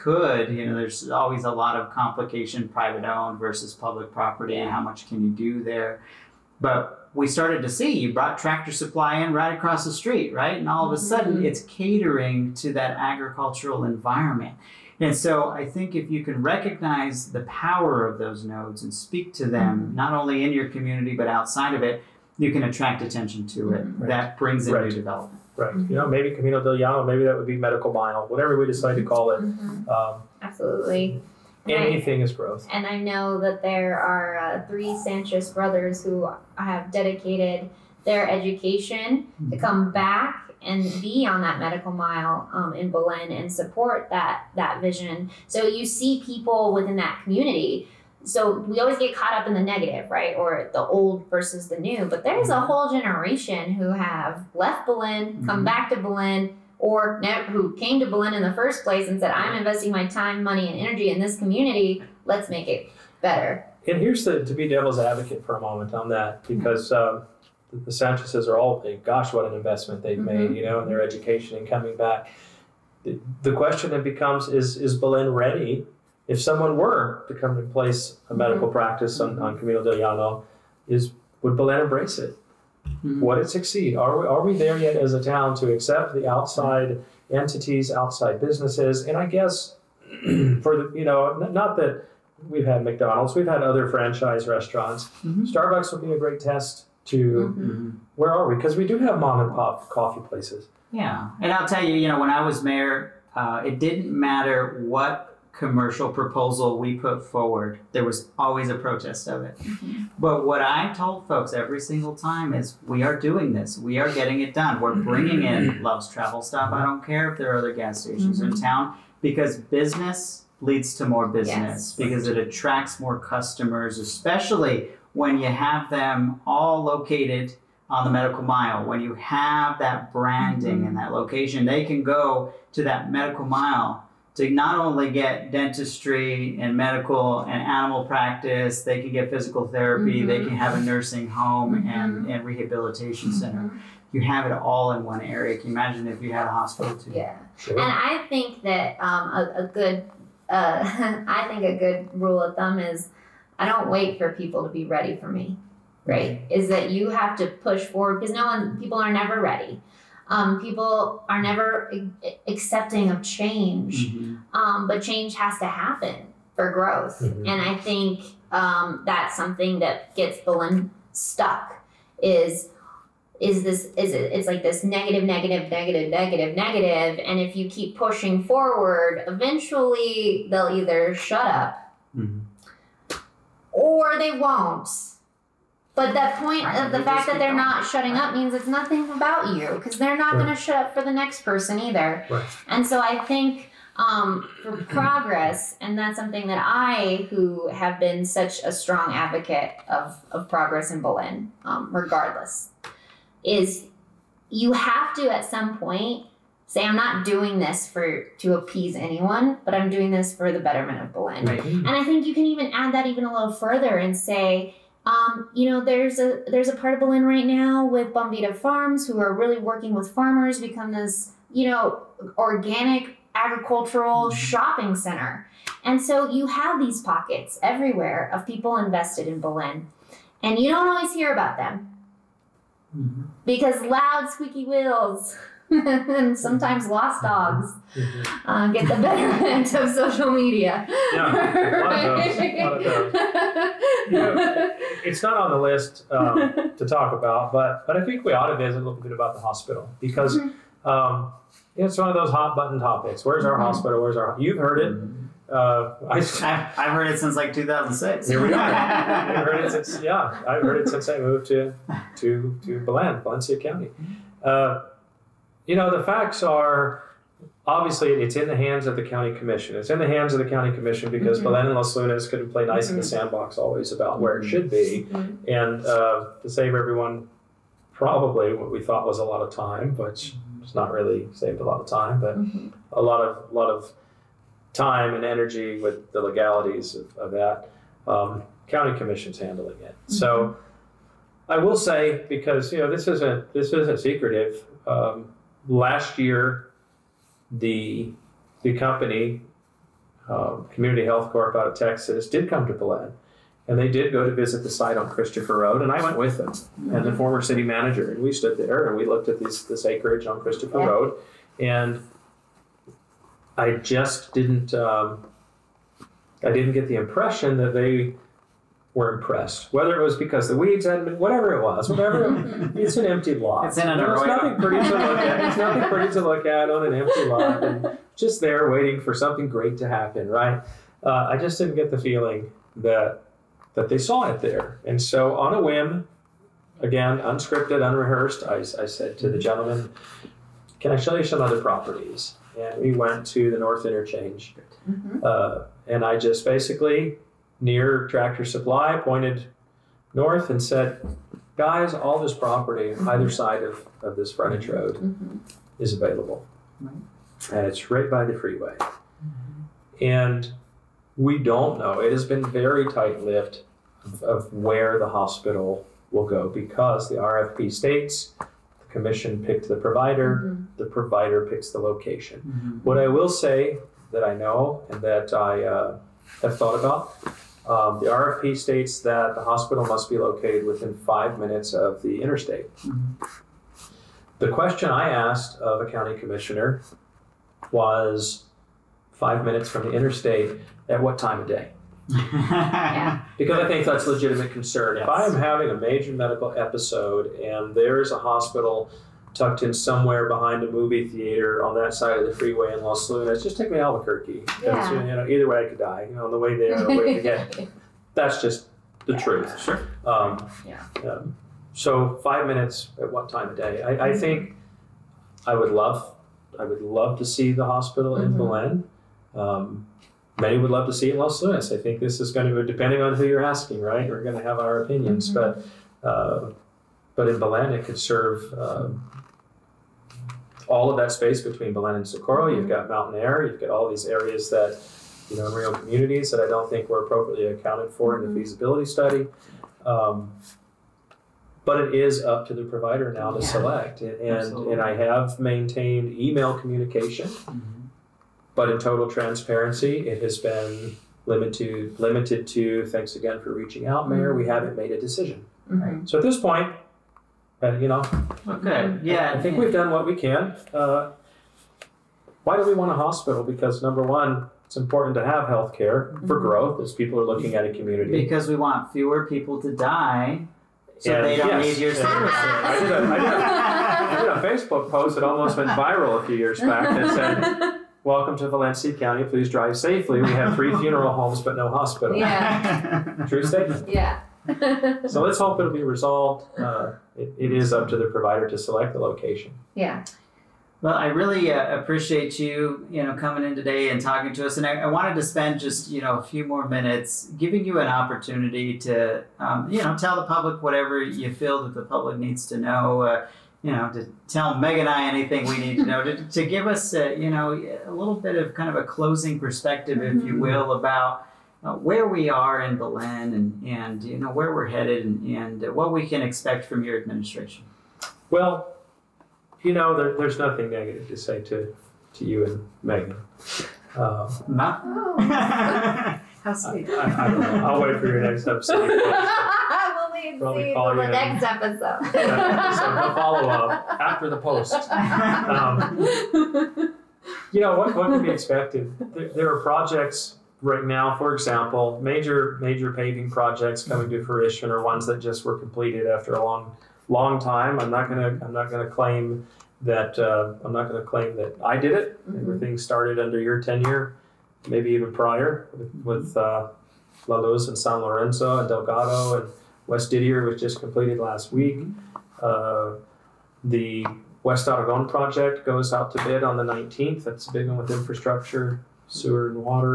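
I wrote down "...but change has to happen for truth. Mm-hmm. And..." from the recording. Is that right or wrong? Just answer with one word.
wrong.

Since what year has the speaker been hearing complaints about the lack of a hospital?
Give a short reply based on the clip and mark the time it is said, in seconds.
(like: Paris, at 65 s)
2006, at 257 s.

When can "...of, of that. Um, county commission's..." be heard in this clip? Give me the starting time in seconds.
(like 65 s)
286 s.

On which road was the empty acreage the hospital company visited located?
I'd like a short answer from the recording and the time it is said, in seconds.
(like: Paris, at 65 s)
Christopher Road, at 310 s.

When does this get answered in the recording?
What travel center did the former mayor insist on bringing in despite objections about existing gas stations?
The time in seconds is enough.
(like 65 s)
115 s.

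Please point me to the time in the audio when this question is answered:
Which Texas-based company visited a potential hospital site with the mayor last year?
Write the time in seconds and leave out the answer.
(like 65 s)
300 s.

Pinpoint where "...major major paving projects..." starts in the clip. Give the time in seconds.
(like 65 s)
542 s.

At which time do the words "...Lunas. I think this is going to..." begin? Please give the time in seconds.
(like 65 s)
421 s.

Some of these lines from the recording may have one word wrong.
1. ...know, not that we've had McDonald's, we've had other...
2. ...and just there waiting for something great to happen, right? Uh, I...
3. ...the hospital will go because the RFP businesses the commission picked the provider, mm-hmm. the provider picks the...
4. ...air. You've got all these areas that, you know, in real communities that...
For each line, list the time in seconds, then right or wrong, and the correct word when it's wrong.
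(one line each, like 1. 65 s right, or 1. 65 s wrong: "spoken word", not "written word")
1. 91 s right
2. 327 s right
3. 364 s wrong: "states", not "businesses"
4. 433 s right.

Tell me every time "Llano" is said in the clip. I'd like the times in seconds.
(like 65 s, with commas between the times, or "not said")
26 s, 79 s.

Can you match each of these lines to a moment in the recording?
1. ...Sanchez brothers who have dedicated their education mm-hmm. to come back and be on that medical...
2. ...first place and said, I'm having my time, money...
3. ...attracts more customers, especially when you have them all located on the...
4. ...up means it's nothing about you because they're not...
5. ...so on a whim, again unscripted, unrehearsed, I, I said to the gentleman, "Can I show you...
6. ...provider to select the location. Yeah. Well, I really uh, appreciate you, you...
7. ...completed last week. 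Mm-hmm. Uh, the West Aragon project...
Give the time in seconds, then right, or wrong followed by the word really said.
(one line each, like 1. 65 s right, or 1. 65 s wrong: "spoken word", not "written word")
1. 34 s right
2. 58 s wrong: "investing", not "having"
3. 122 s right
4. 188 s right
5. 335 s right
6. 488 s right
7. 560 s right.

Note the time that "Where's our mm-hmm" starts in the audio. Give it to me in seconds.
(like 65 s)
253 s.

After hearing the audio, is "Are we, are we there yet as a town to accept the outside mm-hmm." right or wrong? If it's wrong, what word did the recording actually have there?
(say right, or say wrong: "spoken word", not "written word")
right.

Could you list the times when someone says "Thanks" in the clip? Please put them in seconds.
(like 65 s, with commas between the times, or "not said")
452 s.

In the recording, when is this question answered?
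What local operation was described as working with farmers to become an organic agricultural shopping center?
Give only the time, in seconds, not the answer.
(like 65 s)
218 s.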